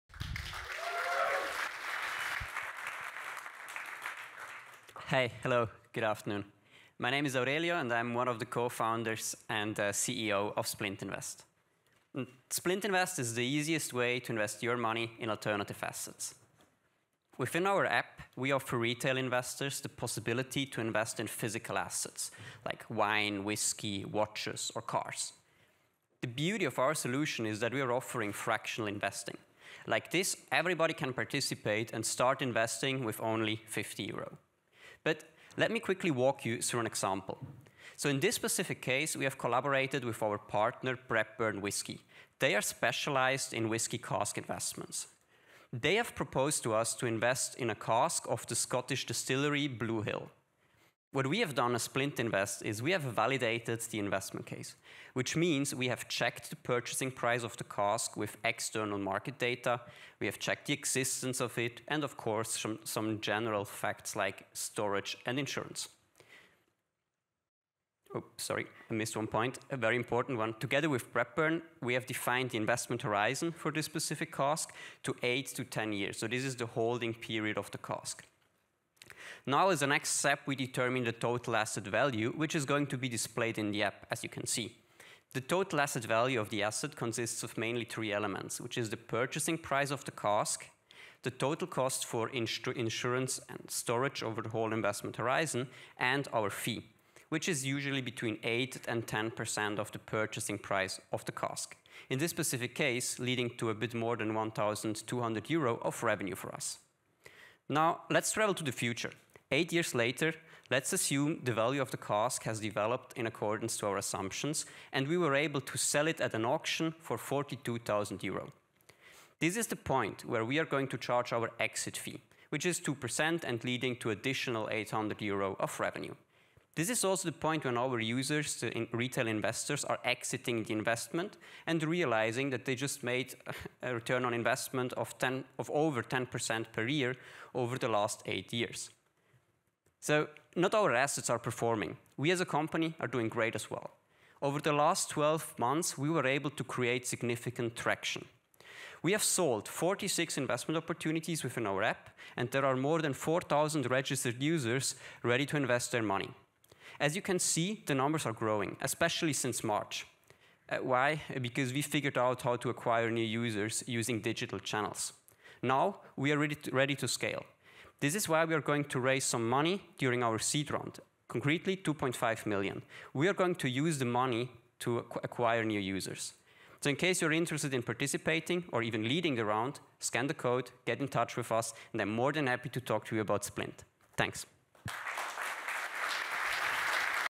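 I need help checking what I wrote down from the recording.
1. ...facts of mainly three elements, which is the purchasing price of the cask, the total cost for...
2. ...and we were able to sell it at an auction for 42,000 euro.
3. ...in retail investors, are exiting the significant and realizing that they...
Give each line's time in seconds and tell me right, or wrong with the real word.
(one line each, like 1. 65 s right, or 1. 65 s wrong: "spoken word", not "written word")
1. 86 s wrong: "consists", not "facts"
2. 114 s right
3. 128 s wrong: "investment", not "significant".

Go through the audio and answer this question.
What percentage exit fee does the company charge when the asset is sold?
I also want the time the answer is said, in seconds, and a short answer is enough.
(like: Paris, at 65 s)
2%, at 122 s.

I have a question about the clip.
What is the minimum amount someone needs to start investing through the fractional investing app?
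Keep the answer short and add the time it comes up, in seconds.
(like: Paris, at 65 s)
50 euro, at 33 s.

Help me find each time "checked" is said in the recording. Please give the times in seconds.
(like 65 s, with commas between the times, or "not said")
56 s, 60 s.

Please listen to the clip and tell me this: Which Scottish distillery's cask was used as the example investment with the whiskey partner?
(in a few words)
Blue Hill.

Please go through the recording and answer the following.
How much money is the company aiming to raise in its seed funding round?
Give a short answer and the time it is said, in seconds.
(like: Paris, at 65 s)
2.5 million, at 171 s.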